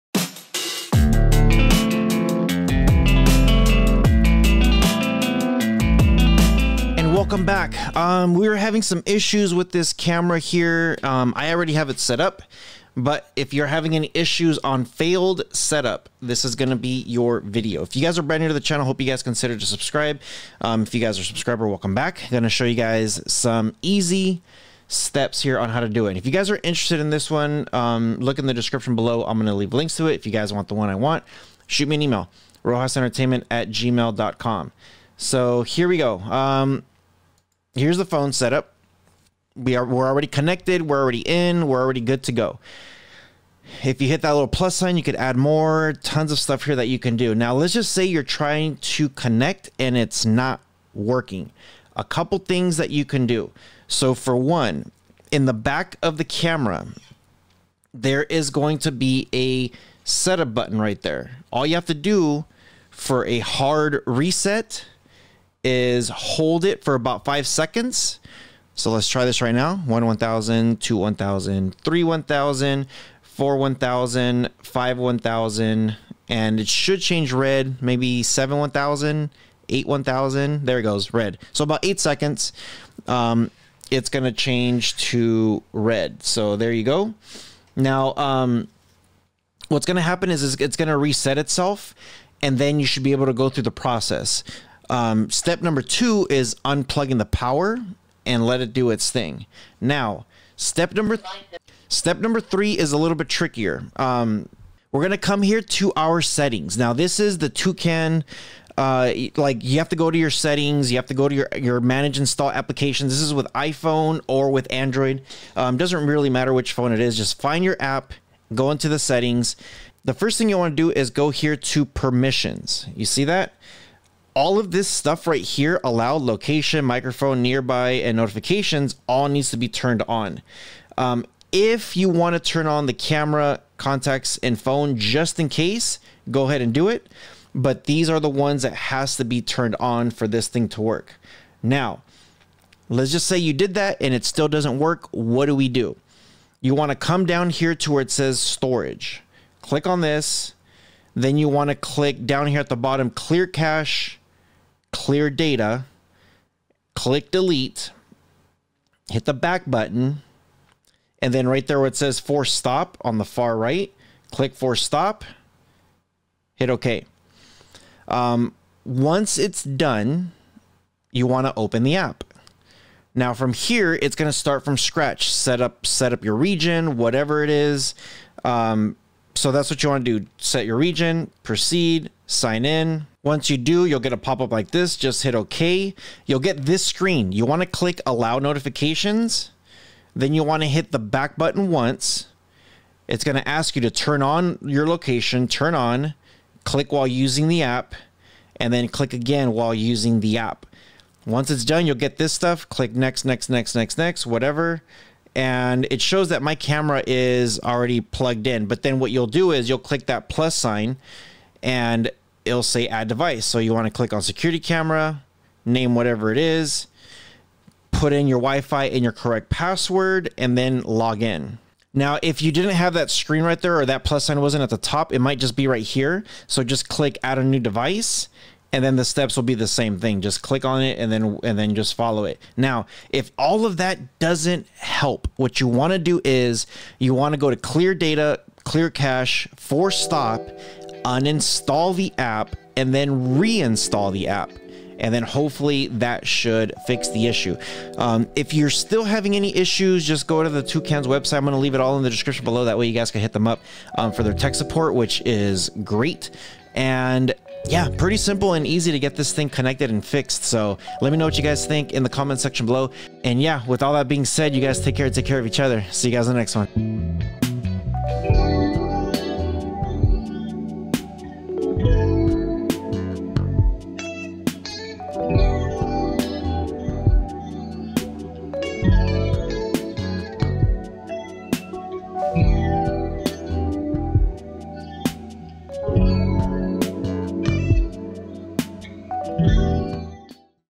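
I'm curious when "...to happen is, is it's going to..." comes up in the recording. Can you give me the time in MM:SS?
01:29.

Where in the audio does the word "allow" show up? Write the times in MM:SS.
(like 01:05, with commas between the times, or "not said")
02:05, 03:08.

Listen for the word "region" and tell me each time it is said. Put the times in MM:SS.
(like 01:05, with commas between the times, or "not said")
02:56, 03:00.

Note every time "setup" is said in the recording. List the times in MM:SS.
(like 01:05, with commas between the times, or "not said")
00:15, 00:38, 01:00.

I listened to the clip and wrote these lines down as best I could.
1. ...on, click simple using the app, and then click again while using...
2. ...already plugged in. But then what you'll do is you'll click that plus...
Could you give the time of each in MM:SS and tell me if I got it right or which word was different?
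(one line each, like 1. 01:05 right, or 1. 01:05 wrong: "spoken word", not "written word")
1. 03:15 wrong: "while", not "simple"
2. 03:27 right.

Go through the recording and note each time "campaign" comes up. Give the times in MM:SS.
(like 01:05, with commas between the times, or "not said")
not said.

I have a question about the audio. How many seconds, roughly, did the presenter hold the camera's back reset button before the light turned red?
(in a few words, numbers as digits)
8.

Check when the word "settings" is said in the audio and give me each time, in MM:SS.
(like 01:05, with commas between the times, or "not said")
01:46, 01:50, 01:58.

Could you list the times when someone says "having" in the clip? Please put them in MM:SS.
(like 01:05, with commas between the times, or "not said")
00:08, 00:13, 04:09.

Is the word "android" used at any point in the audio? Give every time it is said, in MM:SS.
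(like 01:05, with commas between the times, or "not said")
01:54.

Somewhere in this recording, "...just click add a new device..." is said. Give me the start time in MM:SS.
03:46.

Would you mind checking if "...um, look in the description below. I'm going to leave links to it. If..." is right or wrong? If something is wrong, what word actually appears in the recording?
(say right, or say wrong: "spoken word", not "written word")
right.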